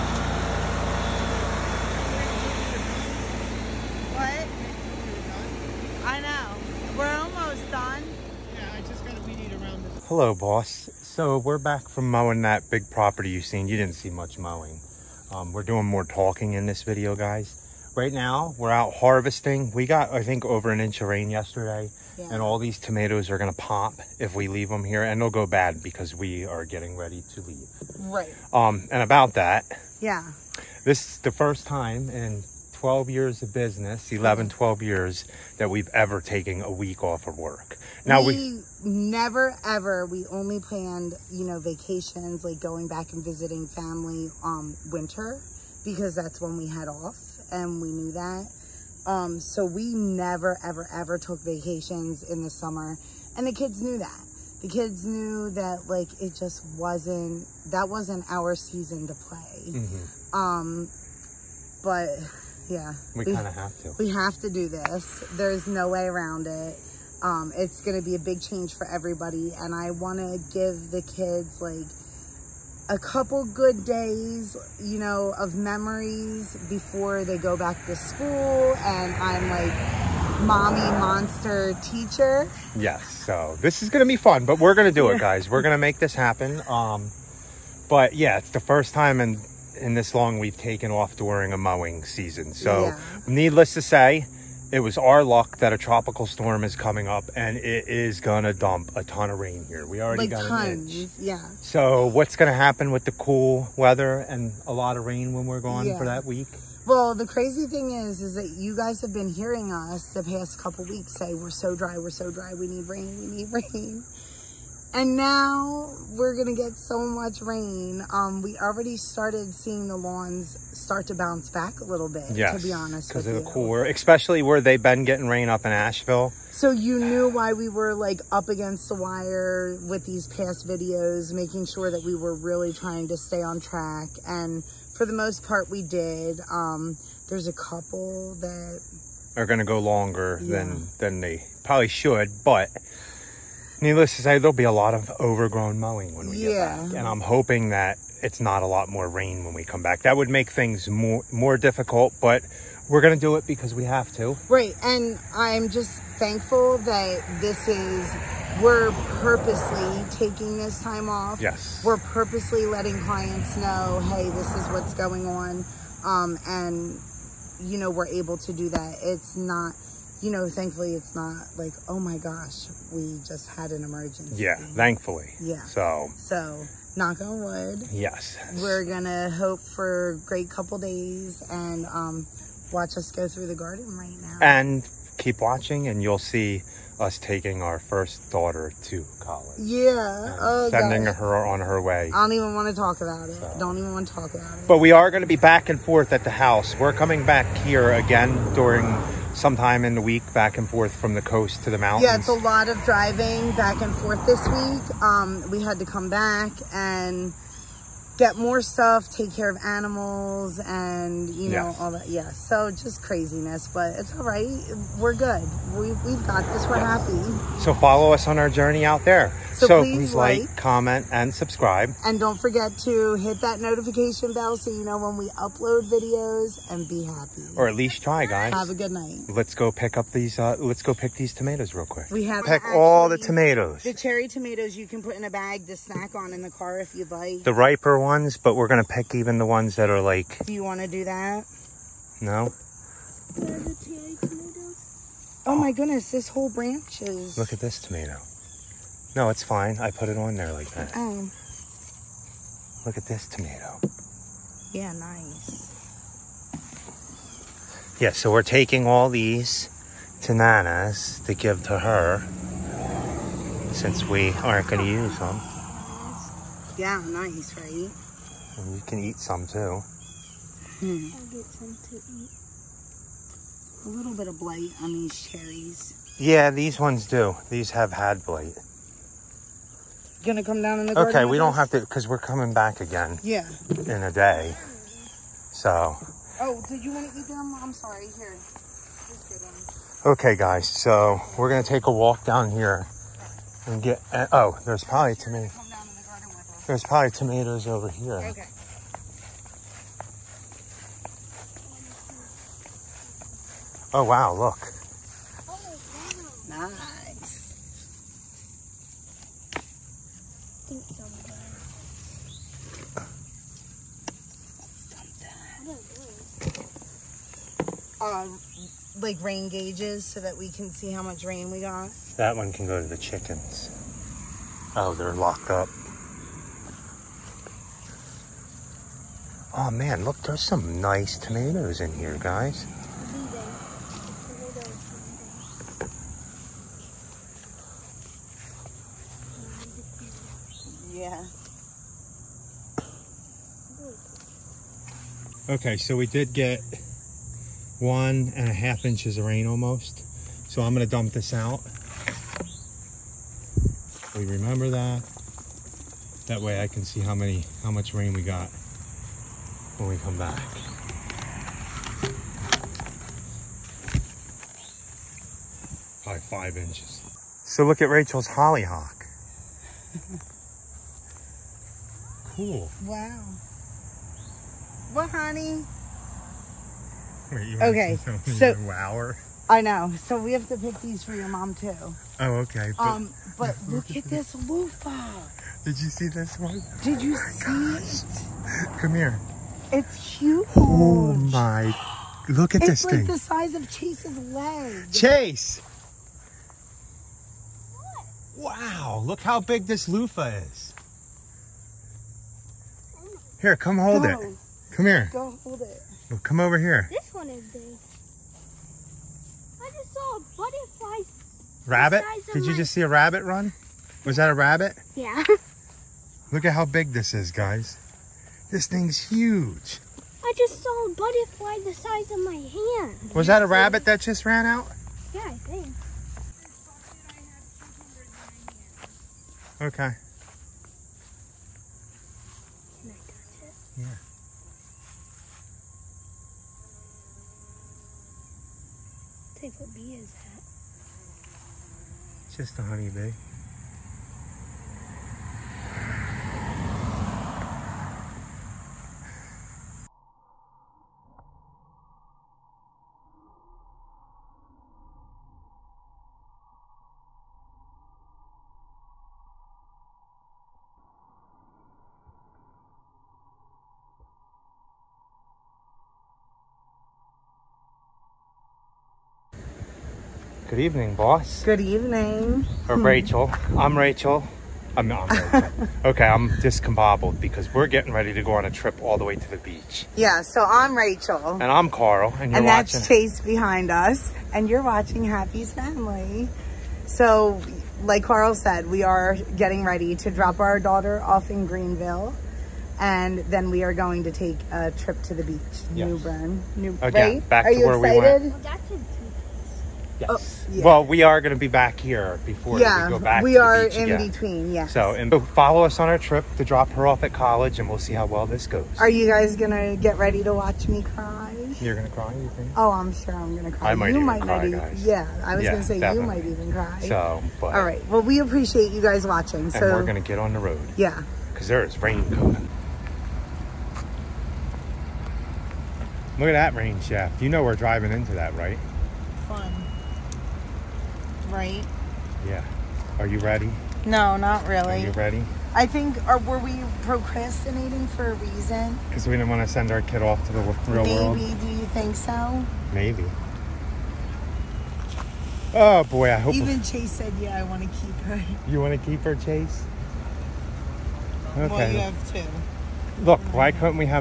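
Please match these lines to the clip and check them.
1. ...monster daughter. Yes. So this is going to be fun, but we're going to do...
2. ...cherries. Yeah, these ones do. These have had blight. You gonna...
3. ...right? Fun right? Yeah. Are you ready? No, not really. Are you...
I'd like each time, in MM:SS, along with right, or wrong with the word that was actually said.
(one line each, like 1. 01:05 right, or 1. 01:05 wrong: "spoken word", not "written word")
1. 01:20 wrong: "teacher", not "daughter"
2. 04:35 right
3. 08:48 right.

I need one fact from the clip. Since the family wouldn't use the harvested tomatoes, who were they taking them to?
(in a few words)
Nana.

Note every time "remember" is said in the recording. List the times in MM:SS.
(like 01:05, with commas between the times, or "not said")
05:54.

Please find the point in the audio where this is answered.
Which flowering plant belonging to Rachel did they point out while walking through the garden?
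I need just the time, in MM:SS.
06:08.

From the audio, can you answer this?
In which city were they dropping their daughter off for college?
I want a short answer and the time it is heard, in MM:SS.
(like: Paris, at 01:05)
Greenville, at 08:11.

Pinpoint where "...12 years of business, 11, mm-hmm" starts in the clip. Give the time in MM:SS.
00:32.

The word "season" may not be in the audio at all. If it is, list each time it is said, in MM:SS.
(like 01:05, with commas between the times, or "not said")
00:58, 01:32.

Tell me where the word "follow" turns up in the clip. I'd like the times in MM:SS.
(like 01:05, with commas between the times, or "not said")
03:37, 08:25.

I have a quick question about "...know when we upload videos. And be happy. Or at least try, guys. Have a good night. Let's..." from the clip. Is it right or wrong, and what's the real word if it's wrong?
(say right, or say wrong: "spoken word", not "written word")
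right.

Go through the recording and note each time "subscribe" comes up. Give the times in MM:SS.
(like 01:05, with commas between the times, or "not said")
03:41.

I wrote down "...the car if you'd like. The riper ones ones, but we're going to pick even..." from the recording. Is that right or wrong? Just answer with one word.
right.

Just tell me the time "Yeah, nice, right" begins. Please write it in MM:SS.
04:26.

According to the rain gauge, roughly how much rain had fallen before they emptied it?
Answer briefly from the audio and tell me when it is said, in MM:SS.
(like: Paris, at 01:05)
1.5 inches, at 05:47.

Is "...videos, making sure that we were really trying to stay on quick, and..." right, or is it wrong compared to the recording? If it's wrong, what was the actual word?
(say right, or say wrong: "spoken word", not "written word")
wrong: "track", not "quick".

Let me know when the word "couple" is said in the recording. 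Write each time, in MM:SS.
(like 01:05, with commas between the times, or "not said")
01:12, 01:50, 02:17, 03:00.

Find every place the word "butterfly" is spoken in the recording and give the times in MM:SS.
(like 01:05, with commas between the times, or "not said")
06:50, 07:00.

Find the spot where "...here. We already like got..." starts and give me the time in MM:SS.
01:39.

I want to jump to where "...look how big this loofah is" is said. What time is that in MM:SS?
06:39.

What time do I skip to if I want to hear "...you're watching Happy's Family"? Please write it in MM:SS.
08:04.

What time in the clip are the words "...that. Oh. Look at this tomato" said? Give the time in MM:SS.
04:10.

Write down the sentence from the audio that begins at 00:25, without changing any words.
And they'll go bad because we are getting ready to leave.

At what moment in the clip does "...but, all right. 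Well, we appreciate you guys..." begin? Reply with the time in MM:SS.
08:37.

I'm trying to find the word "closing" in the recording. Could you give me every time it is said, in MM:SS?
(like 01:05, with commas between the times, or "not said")
not said.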